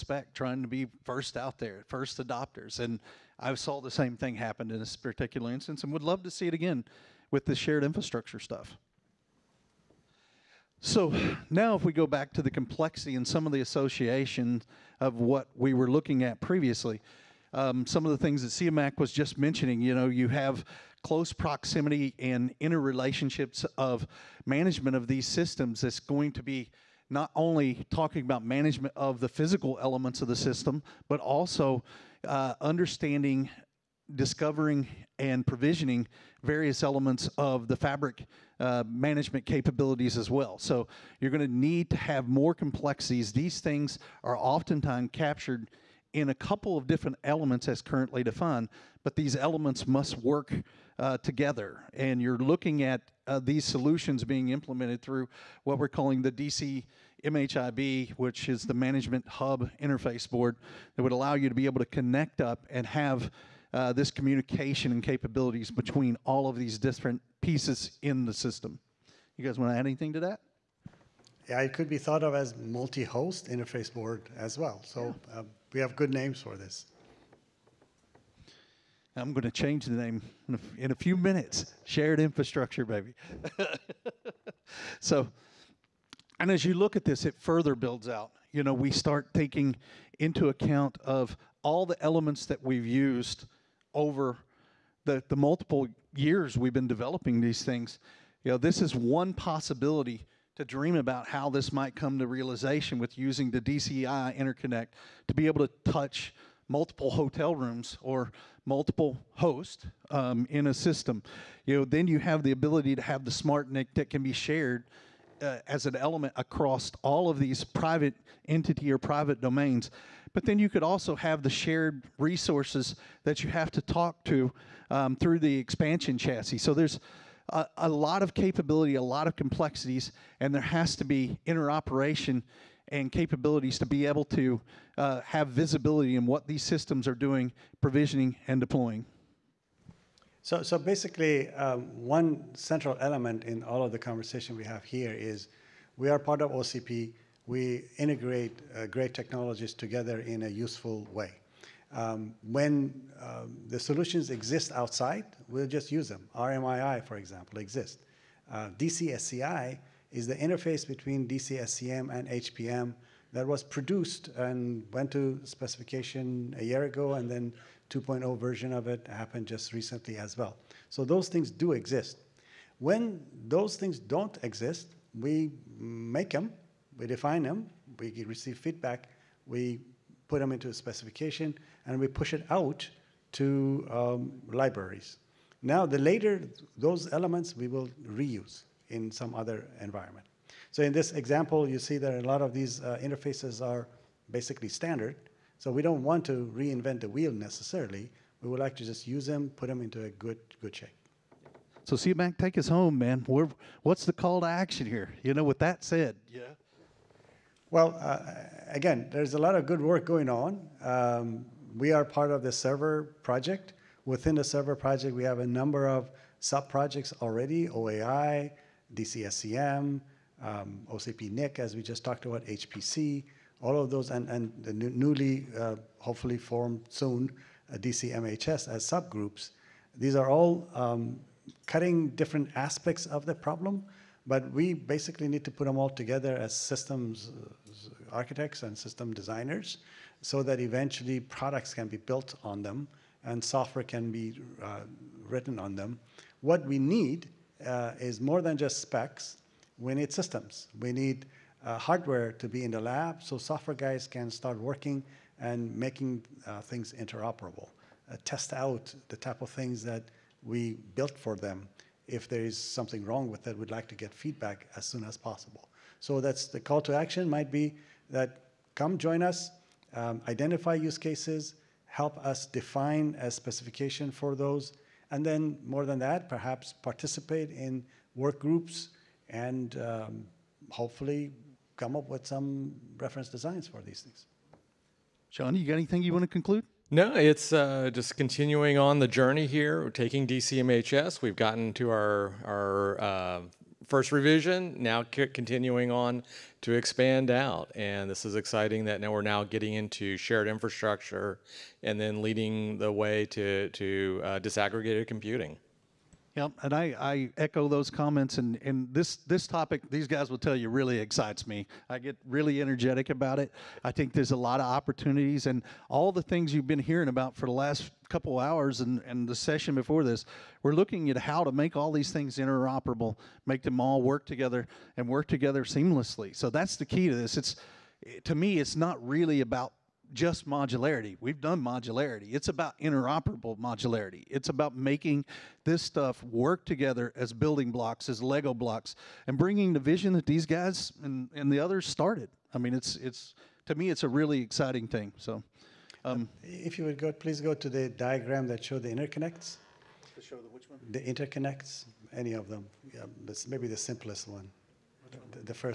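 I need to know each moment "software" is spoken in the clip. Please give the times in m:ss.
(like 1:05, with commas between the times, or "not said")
4:03, 4:13.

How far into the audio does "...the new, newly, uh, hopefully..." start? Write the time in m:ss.
3:44.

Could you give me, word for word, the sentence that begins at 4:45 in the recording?
John, you got anything you want to conclude?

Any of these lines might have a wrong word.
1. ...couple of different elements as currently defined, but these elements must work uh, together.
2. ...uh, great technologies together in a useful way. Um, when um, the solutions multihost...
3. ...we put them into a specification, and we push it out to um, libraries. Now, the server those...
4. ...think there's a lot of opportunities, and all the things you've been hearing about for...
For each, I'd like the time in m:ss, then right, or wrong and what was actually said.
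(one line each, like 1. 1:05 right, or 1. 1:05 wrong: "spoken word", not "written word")
1. 0:46 right
2. 2:28 wrong: "exist", not "multihost"
3. 2:59 wrong: "later", not "server"
4. 5:13 right.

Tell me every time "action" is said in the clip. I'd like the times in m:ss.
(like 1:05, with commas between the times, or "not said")
3:24, 4:26.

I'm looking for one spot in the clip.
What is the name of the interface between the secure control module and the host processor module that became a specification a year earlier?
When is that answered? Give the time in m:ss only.
2:38.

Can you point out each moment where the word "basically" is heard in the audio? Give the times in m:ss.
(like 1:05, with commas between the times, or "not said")
2:20, 3:14, 3:54.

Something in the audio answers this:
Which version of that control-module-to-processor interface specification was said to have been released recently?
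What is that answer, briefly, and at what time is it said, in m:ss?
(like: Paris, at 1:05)
2.0, at 2:47.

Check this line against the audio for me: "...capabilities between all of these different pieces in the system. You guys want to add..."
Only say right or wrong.
right.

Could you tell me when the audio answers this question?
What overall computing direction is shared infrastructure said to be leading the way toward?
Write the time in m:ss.
5:04.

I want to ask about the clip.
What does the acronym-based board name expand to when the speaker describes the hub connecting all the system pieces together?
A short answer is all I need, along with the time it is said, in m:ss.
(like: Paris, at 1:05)
Management Hub Interface Board, at 0:58.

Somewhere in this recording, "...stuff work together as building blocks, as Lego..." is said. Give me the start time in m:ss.
5:35.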